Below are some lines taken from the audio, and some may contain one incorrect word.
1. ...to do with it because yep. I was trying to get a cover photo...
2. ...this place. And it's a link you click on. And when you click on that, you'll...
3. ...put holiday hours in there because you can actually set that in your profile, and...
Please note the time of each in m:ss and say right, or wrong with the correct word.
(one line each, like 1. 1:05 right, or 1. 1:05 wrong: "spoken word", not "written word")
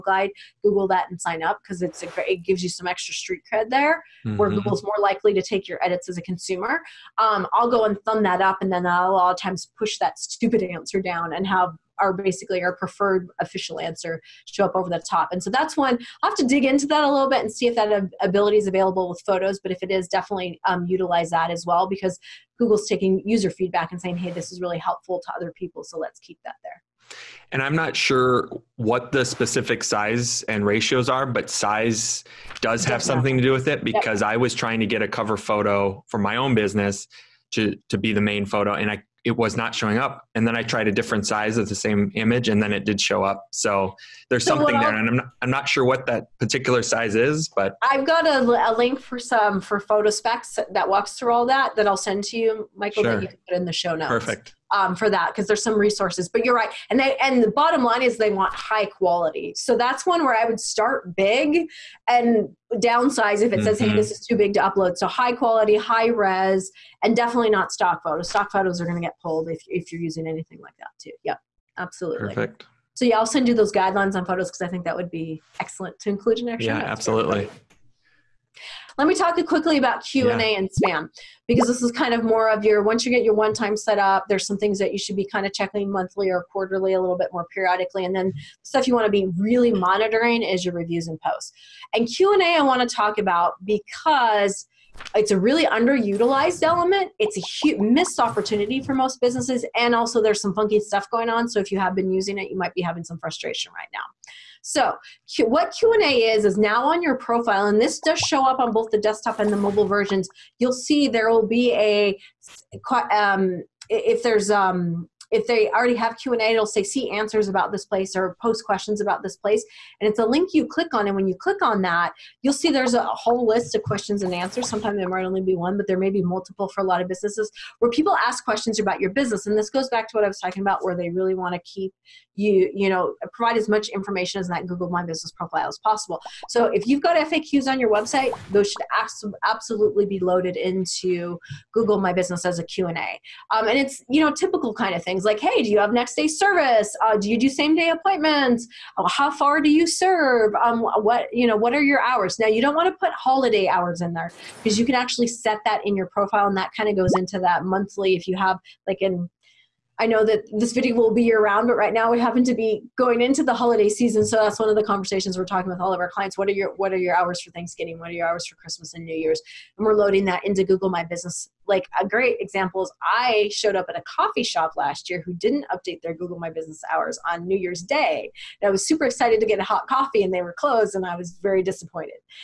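1. 0:33 right
2. 1:59 right
3. 2:32 right.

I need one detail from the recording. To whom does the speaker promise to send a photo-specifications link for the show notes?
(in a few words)
Michael.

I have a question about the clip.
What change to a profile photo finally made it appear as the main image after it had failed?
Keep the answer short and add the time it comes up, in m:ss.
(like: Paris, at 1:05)
A different size, at 0:40.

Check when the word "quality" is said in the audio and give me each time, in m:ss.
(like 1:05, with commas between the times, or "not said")
0:58, 1:05.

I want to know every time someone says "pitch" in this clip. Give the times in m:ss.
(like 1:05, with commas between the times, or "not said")
not said.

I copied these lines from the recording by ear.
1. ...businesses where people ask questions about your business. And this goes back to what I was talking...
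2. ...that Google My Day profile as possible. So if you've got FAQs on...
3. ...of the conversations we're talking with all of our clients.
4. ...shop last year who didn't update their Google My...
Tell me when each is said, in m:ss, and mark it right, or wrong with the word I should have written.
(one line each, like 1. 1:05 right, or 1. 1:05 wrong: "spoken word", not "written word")
1. 2:07 right
2. 2:14 wrong: "Business", not "Day"
3. 2:44 right
4. 2:54 right.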